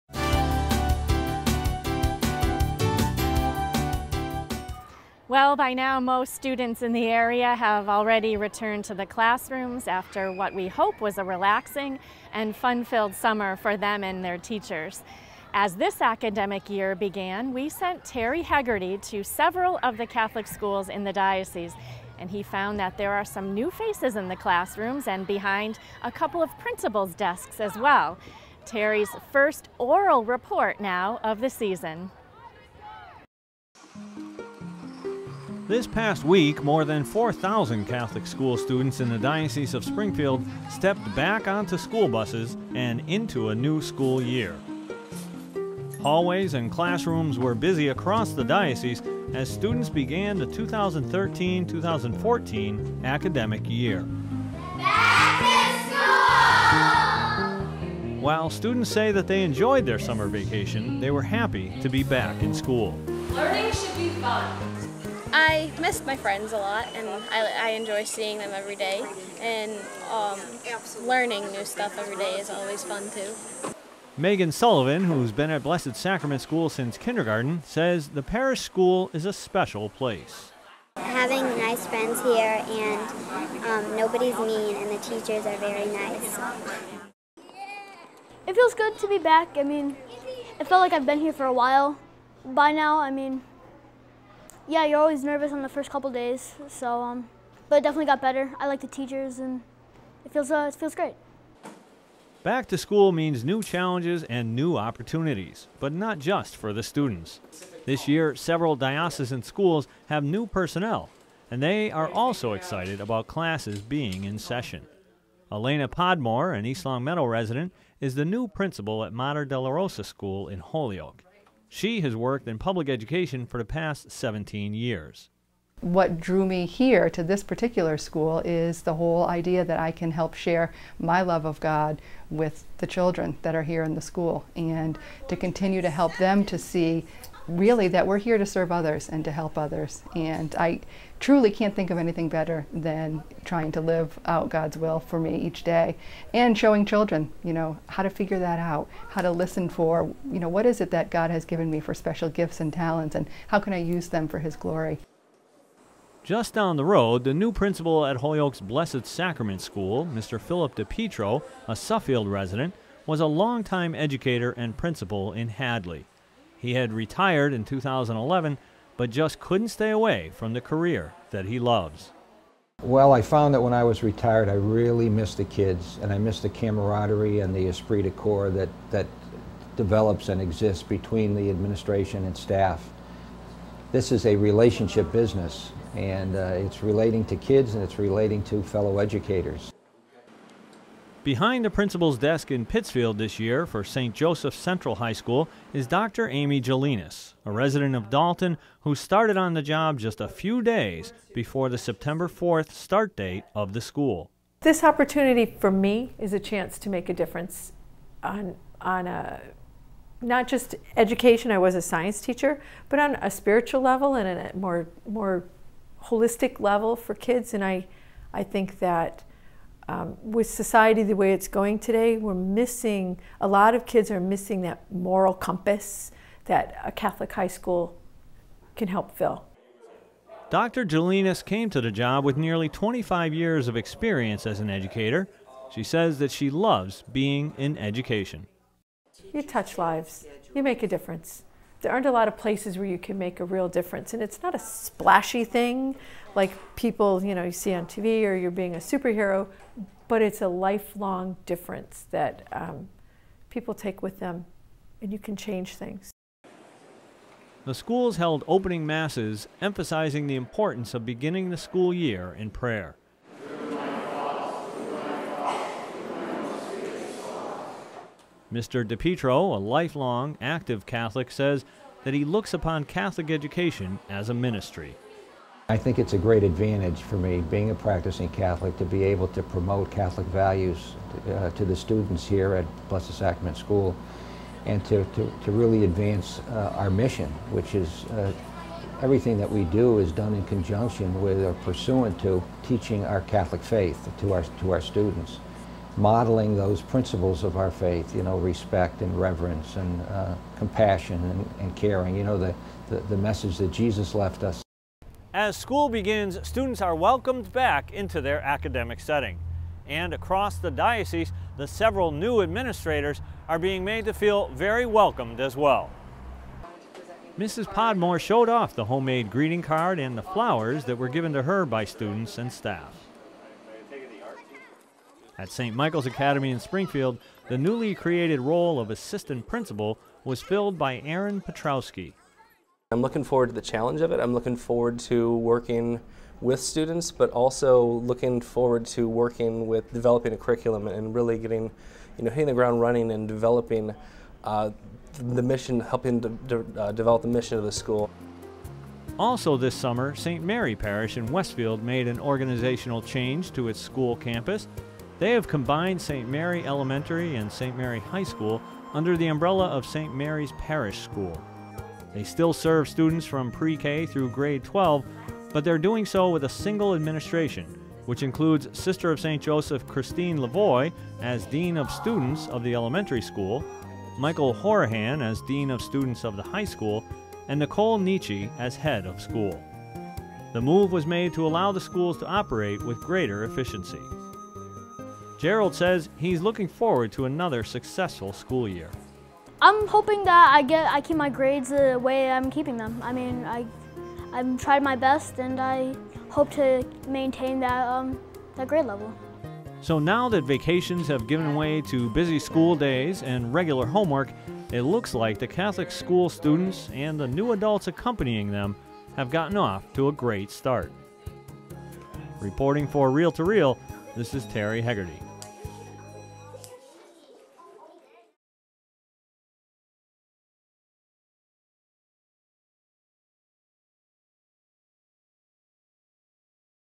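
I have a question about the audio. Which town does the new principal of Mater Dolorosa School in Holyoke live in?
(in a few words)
East Longmeadow.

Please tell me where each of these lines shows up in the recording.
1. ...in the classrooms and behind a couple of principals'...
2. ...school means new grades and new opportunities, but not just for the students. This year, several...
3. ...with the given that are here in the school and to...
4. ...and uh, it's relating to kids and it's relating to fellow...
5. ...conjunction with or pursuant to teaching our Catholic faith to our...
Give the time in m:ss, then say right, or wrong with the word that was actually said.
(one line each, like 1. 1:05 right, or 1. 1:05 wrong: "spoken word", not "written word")
1. 0:24 right
2. 1:42 wrong: "challenges", not "grades"
3. 2:12 wrong: "children", not "given"
4. 3:05 right
5. 4:50 right.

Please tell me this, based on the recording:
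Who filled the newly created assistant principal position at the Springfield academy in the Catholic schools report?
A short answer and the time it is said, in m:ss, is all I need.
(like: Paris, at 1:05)
Aaron Petrowski, at 5:30.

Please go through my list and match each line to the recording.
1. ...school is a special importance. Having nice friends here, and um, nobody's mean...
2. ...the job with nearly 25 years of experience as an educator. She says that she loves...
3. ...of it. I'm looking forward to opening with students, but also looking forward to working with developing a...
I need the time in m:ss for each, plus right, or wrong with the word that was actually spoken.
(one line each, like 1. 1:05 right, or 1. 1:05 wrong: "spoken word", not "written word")
1. 1:18 wrong: "place", not "importance"
2. 3:51 right
3. 5:34 wrong: "working", not "opening".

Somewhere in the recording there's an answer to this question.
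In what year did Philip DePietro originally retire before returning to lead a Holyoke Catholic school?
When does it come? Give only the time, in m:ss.
2:47.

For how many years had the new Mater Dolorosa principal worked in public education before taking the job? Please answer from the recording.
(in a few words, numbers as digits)
17.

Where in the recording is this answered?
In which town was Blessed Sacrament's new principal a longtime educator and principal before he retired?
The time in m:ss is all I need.
2:45.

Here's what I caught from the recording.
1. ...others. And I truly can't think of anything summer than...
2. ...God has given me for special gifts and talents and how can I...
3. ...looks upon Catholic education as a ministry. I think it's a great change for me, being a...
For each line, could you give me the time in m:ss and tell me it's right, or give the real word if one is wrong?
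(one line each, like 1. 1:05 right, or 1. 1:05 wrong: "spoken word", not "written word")
1. 2:19 wrong: "better", not "summer"
2. 2:31 right
3. 4:32 wrong: "advantage", not "change".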